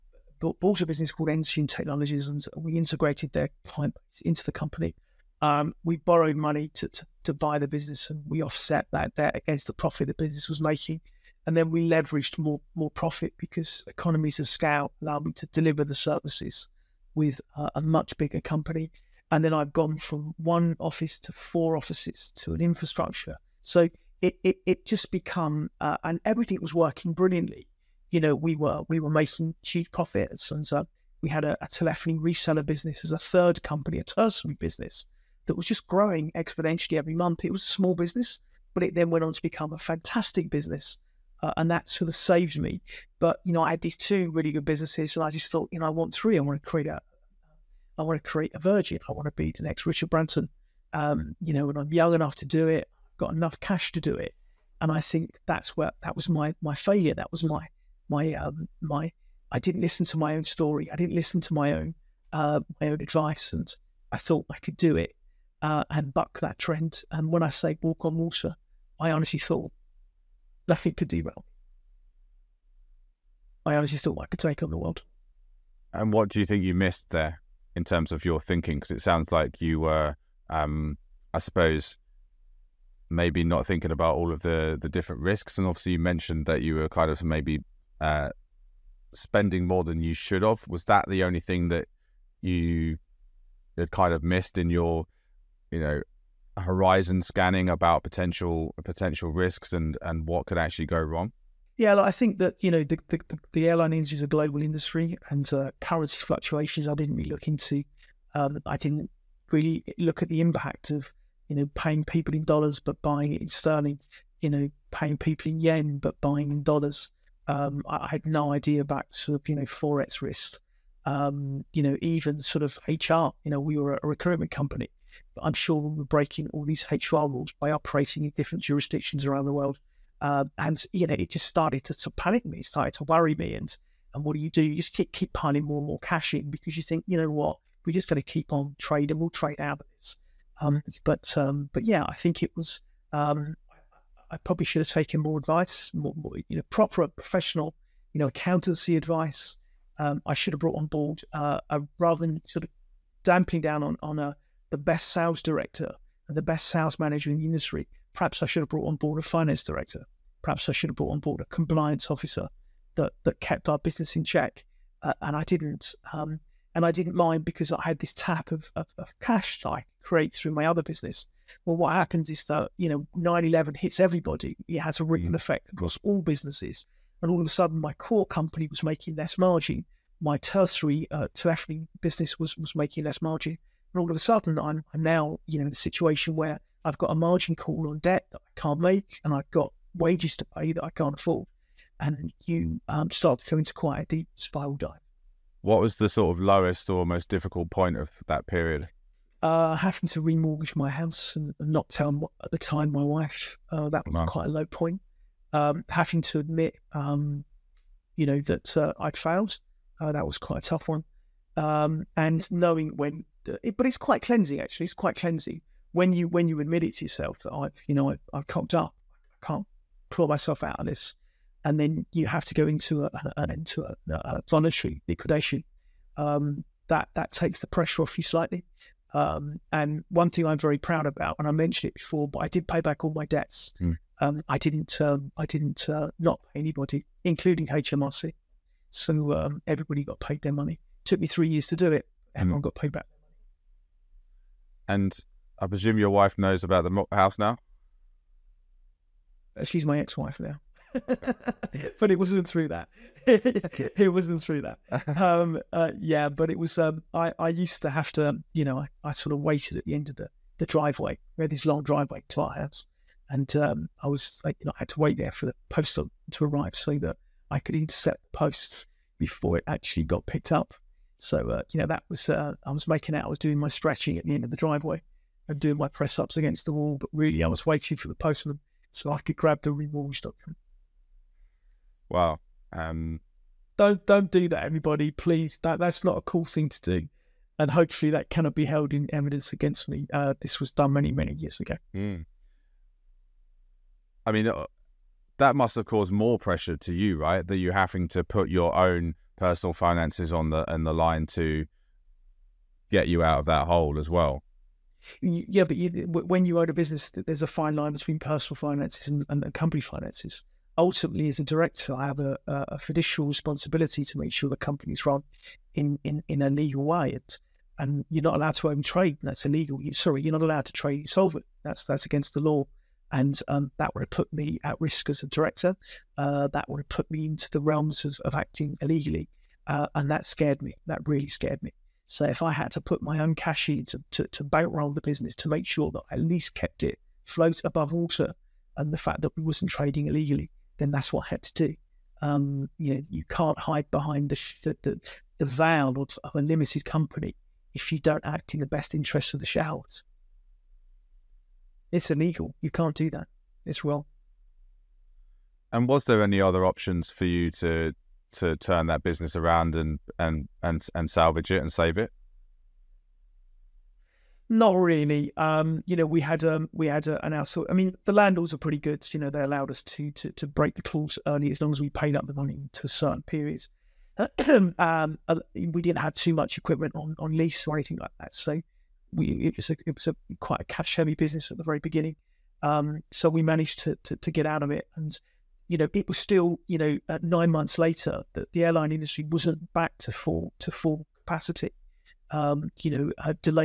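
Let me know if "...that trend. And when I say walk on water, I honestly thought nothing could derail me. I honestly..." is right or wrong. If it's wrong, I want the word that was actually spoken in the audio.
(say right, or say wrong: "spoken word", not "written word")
right.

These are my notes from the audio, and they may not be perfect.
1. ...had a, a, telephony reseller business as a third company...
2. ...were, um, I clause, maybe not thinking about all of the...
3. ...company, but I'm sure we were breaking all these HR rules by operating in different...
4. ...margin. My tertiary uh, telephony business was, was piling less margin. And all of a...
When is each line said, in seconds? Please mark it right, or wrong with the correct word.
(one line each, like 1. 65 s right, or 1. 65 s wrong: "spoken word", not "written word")
1. 31 s right
2. 79 s wrong: "suppose", not "clause"
3. 124 s right
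4. 179 s wrong: "making", not "piling".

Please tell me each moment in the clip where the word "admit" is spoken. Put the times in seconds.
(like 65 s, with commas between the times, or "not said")
206 s, 216 s.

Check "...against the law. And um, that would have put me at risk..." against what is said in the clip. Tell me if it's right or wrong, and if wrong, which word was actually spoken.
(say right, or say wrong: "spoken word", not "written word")
right.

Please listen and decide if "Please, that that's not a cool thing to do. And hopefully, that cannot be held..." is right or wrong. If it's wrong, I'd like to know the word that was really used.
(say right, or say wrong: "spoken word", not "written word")
right.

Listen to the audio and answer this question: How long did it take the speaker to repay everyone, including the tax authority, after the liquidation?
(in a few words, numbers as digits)
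3 years.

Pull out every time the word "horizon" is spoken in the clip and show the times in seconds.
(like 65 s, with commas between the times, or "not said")
96 s.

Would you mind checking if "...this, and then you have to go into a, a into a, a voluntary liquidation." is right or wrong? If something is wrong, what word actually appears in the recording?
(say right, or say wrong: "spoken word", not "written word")
right.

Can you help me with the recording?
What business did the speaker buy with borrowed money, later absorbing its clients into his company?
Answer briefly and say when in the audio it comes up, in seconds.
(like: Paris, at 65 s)
Ensign Technologies, at 1 s.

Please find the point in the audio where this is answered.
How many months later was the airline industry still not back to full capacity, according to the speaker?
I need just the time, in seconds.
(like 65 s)
387 s.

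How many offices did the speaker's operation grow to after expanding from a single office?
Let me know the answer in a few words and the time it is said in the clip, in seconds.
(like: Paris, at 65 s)
4, at 21 s.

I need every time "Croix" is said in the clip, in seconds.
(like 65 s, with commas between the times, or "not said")
not said.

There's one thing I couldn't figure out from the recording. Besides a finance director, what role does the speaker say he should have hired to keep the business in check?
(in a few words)
compliance officer.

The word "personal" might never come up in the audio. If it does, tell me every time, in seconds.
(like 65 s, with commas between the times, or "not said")
299 s, 308 s.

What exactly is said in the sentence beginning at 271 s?
So uh, you know, that was uh, I was making out.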